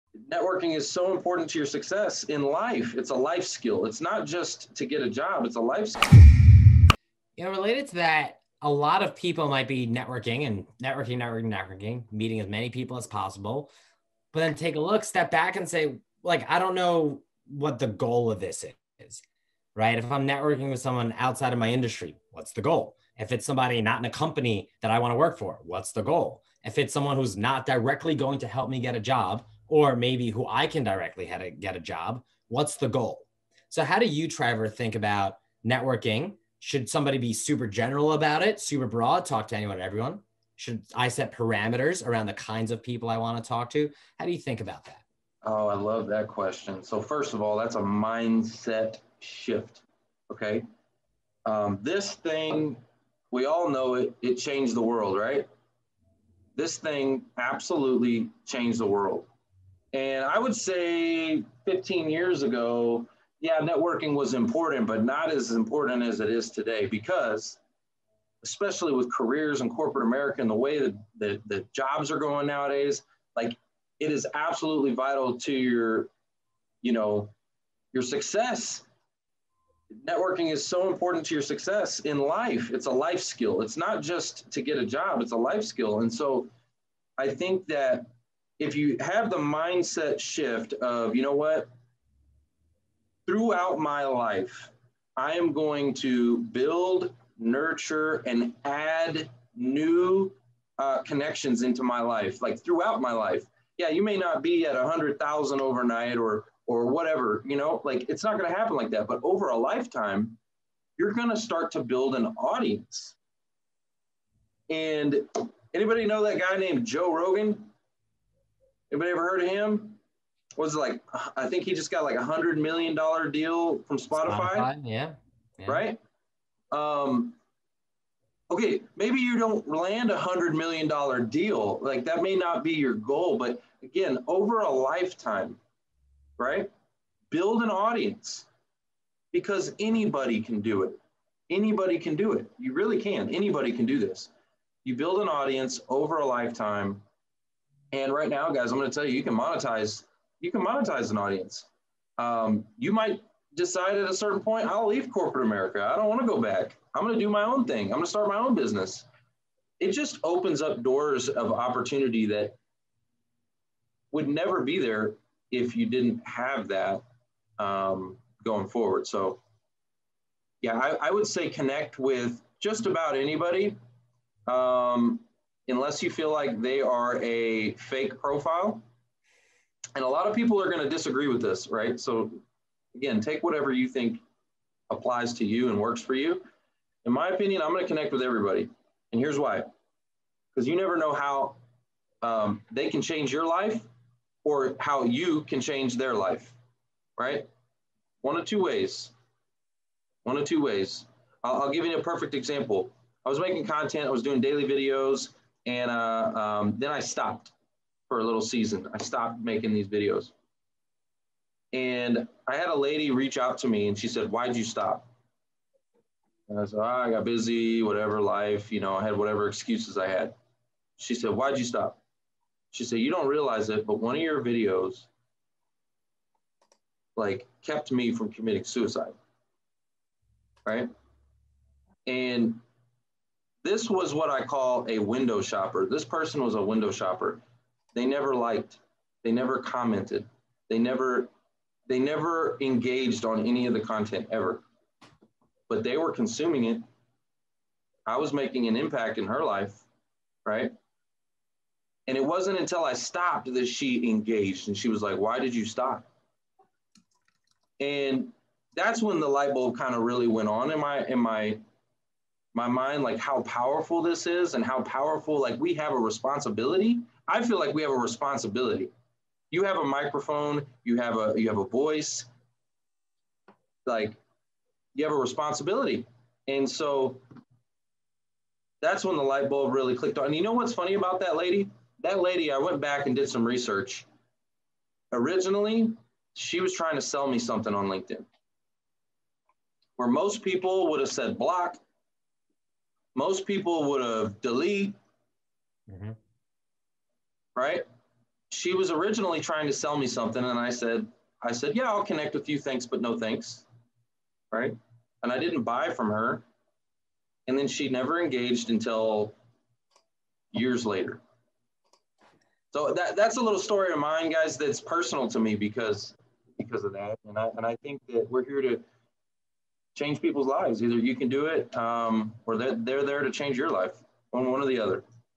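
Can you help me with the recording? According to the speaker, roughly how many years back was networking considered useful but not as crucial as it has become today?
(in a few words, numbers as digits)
15 years.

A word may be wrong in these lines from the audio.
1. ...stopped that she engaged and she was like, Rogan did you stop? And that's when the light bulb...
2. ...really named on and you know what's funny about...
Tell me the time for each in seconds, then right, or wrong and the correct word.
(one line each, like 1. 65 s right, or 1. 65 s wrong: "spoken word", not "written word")
1. 252 s wrong: "Why", not "Rogan"
2. 279 s wrong: "clicked", not "named".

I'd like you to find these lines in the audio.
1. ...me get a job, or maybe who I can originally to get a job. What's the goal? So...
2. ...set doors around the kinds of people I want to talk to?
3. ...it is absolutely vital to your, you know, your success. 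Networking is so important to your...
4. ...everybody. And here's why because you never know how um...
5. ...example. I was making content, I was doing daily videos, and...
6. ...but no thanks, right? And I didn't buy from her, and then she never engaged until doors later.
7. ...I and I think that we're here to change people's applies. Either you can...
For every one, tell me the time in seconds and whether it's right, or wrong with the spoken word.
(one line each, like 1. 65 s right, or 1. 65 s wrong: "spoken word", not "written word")
1. 28 s wrong: "directly", not "originally"
2. 41 s wrong: "parameters", not "doors"
3. 73 s right
4. 188 s right
5. 202 s right
6. 302 s wrong: "years", not "doors"
7. 317 s wrong: "lives", not "applies".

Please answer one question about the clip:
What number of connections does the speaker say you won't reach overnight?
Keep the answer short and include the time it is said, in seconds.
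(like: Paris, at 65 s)
100,000, at 104 s.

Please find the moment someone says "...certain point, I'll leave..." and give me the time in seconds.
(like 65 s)
154 s.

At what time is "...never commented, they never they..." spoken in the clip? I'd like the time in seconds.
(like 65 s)
239 s.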